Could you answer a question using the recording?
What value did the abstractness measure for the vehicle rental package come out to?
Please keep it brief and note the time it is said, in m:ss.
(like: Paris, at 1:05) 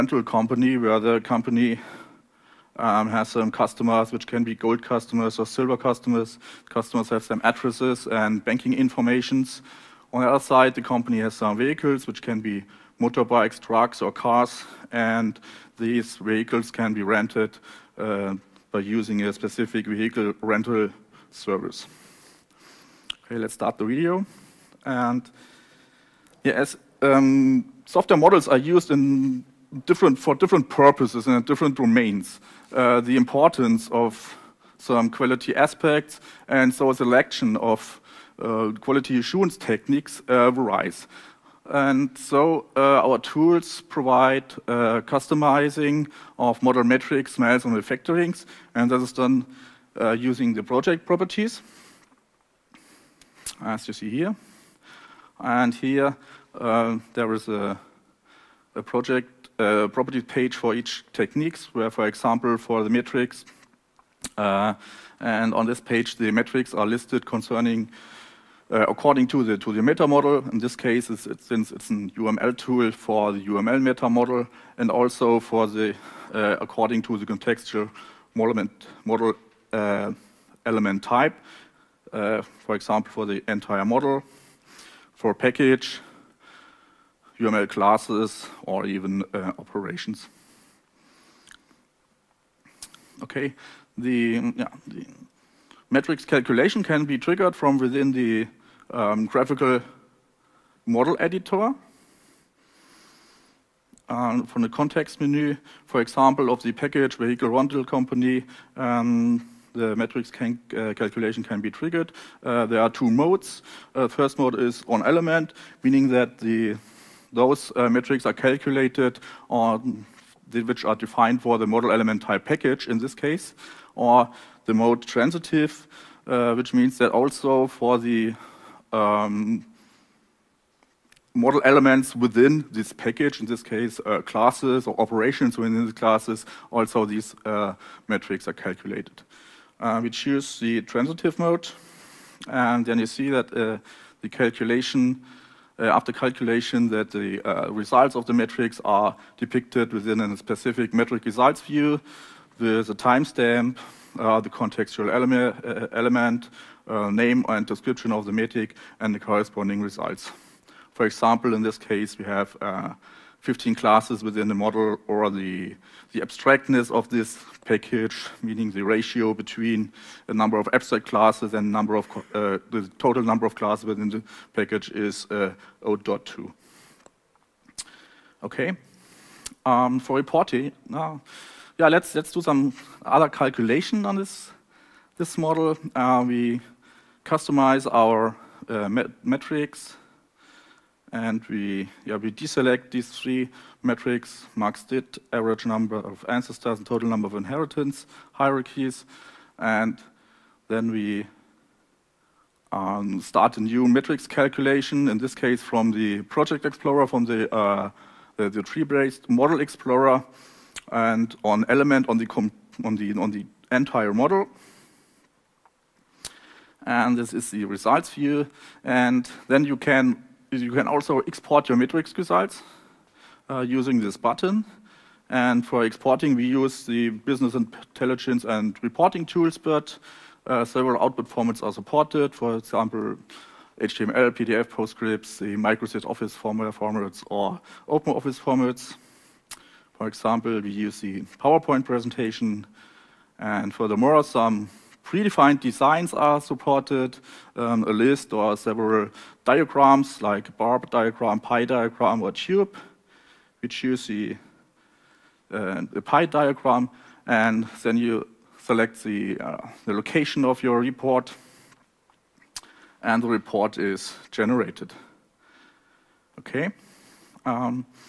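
0.2, at 2:55.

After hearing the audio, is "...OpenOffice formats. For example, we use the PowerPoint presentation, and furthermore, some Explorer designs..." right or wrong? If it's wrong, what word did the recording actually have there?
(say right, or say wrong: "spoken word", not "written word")
wrong: "Predefined", not "Explorer".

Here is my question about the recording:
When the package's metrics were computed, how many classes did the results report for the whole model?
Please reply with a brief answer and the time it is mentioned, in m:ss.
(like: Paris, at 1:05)
15, at 2:43.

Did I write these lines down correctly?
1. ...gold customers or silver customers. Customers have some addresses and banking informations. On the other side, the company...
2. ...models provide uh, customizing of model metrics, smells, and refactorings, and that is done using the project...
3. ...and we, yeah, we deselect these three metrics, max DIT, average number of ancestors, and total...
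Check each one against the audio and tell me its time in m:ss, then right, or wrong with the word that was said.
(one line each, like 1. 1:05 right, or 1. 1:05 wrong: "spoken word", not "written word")
1. 0:04 right
2. 0:43 wrong: "tools", not "models"
3. 3:11 right.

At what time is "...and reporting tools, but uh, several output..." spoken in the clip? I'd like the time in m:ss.
3:48.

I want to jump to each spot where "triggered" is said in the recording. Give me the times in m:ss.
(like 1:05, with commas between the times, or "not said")
1:37, 1:51.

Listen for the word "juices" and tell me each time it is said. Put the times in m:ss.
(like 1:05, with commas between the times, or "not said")
not said.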